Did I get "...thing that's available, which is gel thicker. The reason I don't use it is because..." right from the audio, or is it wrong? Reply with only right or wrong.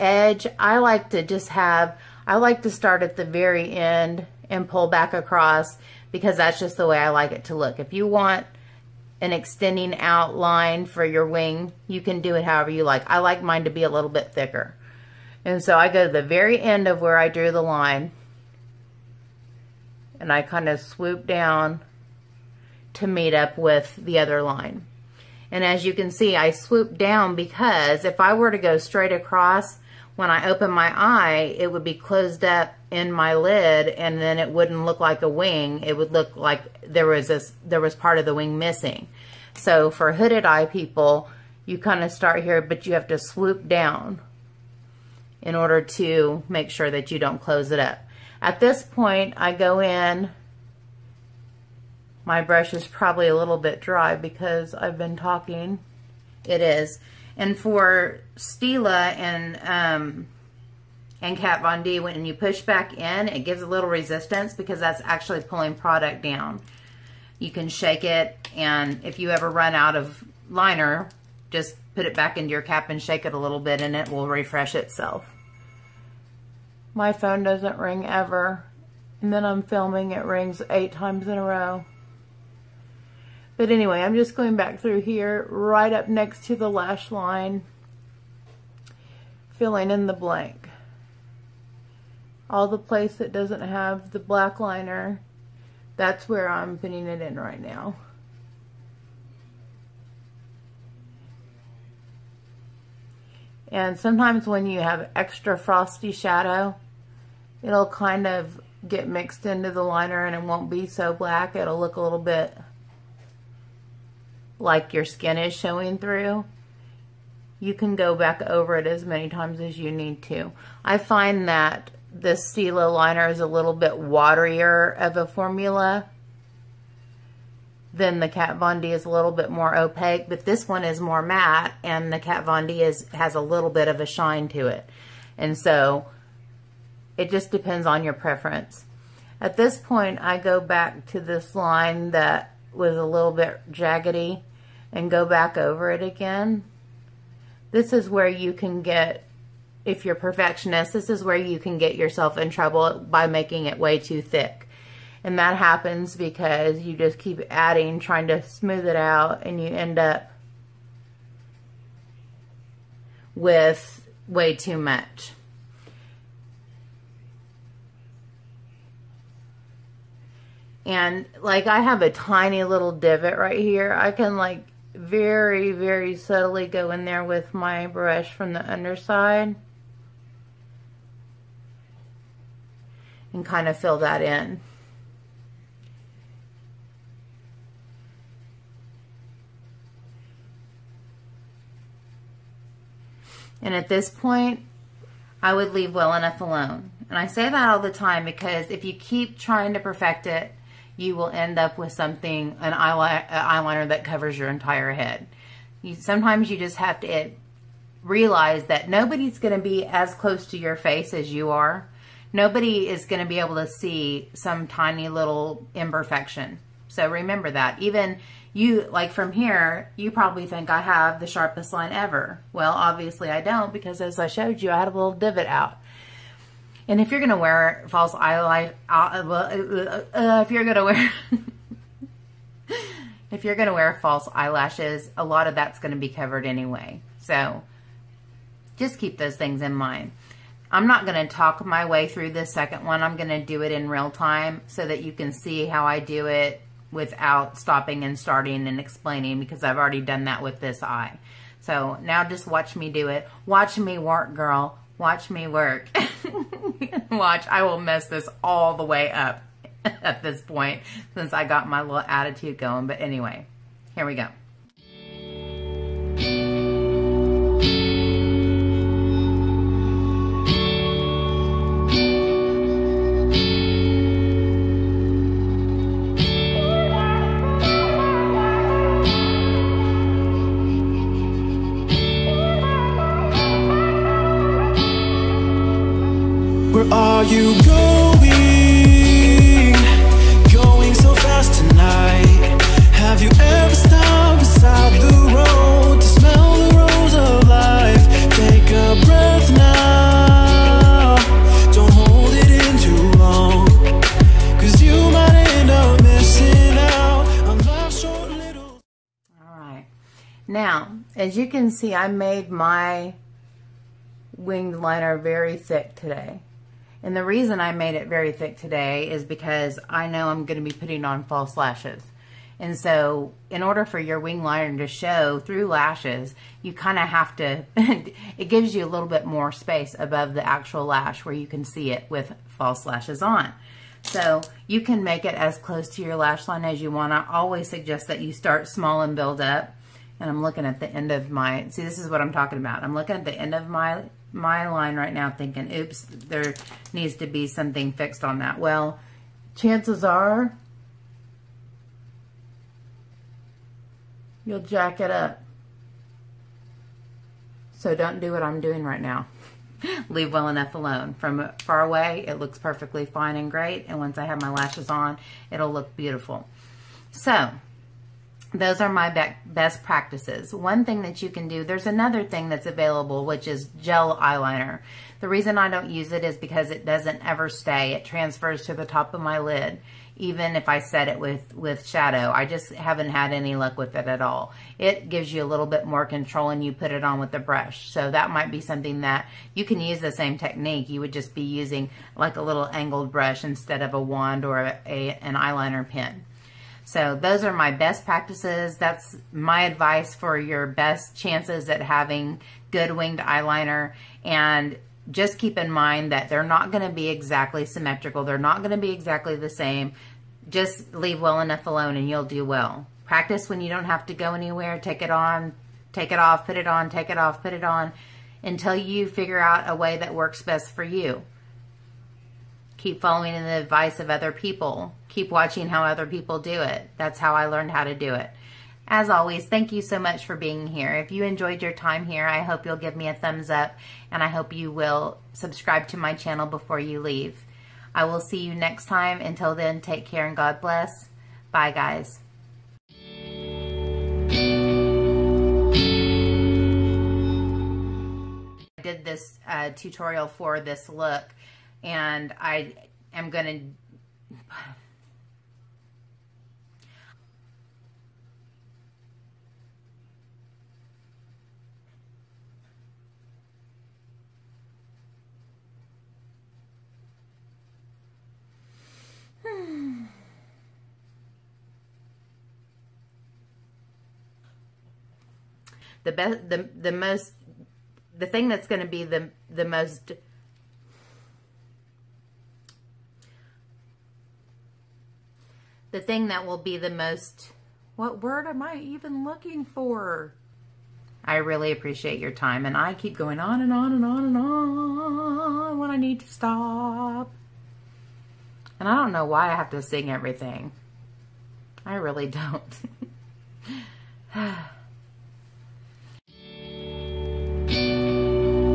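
wrong.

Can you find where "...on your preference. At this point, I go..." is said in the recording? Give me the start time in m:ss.
2:17.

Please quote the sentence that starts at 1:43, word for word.
And sometimes when you have extra frosty shadow, it'll kind of get mixed into the liner and it won't be so black.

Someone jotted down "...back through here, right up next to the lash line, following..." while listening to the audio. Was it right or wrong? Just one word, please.
wrong.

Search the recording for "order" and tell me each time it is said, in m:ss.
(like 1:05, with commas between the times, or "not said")
0:45, 5:23.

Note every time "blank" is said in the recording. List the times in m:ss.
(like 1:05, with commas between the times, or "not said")
1:30.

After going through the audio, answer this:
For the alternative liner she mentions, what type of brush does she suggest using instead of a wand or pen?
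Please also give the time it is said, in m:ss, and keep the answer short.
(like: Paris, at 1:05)
Angled brush, at 6:32.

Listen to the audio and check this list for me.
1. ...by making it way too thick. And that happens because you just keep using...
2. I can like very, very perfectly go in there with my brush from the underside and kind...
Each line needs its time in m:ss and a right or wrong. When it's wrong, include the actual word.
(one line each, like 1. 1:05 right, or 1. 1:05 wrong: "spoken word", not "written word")
1. 2:33 wrong: "adding", not "using"
2. 2:53 wrong: "subtly", not "perfectly".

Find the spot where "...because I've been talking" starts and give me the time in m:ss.
0:54.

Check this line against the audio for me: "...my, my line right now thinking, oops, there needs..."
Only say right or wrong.
right.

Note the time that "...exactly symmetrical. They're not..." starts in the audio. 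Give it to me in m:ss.
6:47.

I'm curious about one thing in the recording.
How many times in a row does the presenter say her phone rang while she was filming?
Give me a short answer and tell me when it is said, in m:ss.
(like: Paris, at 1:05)
8, at 1:20.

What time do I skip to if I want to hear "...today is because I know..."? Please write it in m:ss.
5:18.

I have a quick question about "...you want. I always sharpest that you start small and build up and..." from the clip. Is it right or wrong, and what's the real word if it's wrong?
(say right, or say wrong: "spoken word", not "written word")
wrong: "suggest", not "sharpest".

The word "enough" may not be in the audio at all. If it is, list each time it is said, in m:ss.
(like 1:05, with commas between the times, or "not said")
3:16, 6:00, 6:51.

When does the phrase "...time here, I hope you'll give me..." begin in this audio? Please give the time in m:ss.
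7:11.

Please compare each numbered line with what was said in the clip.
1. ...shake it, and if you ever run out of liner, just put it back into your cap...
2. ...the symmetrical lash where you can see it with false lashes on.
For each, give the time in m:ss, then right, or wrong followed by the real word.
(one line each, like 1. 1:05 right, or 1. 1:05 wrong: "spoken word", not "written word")
1. 1:07 right
2. 5:30 wrong: "actual", not "symmetrical".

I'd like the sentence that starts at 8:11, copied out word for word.
I really appreciate your time and I keep going on and on and on and on when I need to stop.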